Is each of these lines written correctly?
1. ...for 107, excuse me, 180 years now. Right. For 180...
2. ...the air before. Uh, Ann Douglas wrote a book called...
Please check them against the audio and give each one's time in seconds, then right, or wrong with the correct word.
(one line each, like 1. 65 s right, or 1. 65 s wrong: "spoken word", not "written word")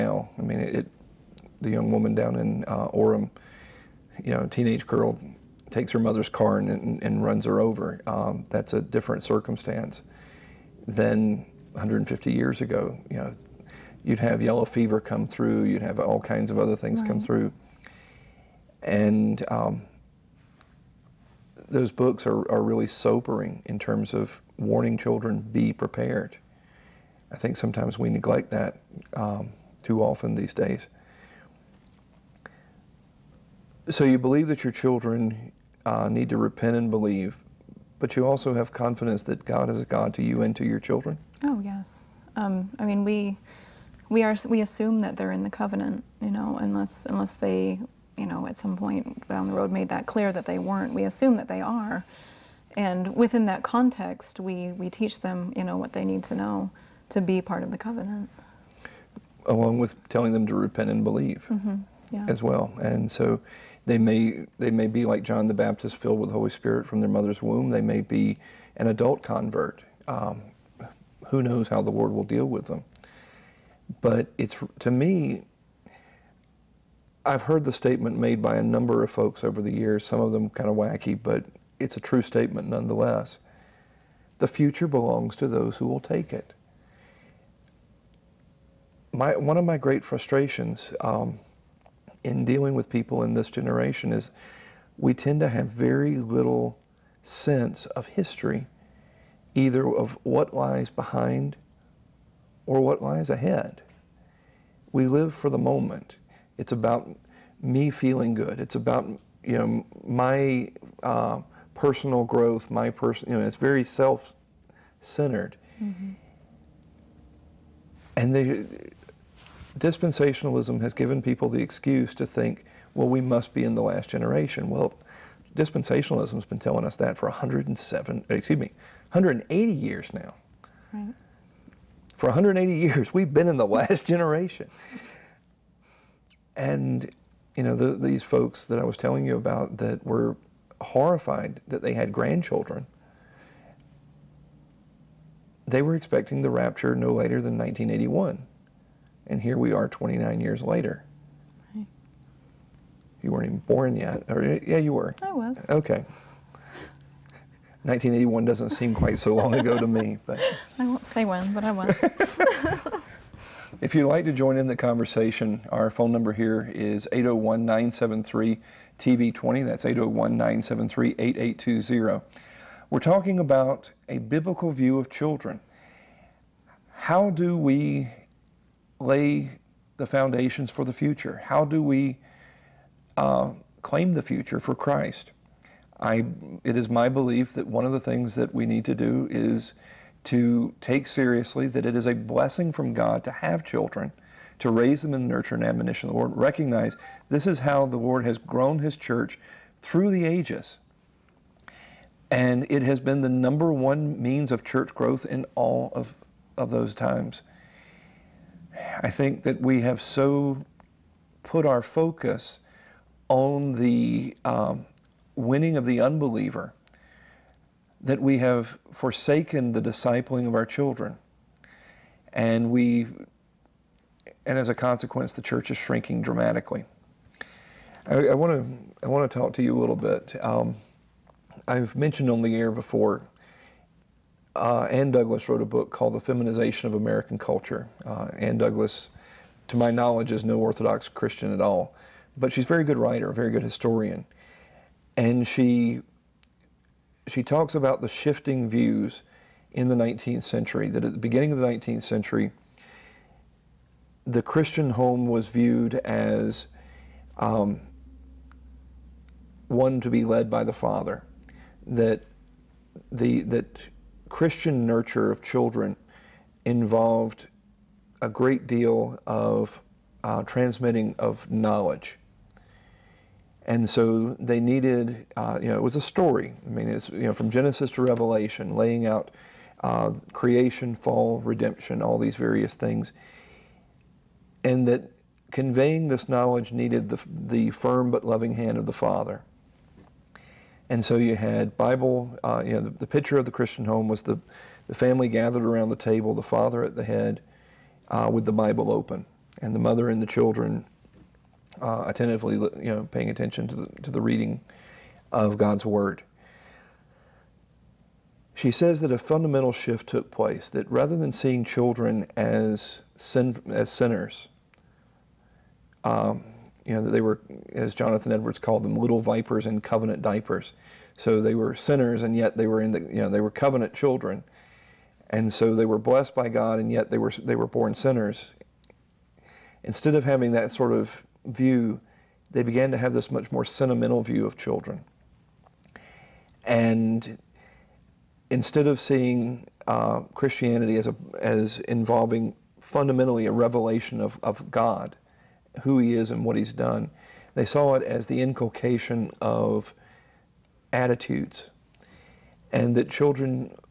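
1. 127 s right
2. 232 s right.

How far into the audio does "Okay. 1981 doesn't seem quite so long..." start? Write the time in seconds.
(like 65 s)
155 s.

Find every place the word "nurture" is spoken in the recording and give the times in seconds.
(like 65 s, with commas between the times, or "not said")
195 s, 264 s.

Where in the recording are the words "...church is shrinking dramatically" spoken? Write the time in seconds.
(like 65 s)
225 s.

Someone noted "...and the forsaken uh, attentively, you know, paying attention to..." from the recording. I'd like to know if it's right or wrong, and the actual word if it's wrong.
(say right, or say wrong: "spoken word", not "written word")
wrong: "children", not "forsaken".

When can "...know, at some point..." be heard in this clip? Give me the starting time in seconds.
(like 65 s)
48 s.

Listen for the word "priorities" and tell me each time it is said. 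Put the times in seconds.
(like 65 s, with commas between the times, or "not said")
not said.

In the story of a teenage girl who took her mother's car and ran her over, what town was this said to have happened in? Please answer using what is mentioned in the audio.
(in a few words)
Orem.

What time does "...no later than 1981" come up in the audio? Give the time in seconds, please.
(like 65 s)
146 s.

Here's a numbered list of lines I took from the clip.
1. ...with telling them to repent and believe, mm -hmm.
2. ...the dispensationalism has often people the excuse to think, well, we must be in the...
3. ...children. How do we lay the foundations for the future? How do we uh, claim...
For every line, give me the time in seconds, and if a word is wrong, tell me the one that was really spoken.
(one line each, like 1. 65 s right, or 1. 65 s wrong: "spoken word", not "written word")
1. 59 s right
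2. 118 s wrong: "given", not "often"
3. 175 s right.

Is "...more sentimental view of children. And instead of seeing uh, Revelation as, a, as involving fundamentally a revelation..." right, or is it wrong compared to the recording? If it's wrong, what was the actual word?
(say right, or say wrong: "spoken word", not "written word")
wrong: "Christianity", not "Revelation".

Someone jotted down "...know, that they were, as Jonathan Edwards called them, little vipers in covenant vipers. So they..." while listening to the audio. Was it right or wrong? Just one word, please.
wrong.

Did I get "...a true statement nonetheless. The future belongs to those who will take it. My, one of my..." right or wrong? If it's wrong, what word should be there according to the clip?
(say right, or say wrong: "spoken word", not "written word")
right.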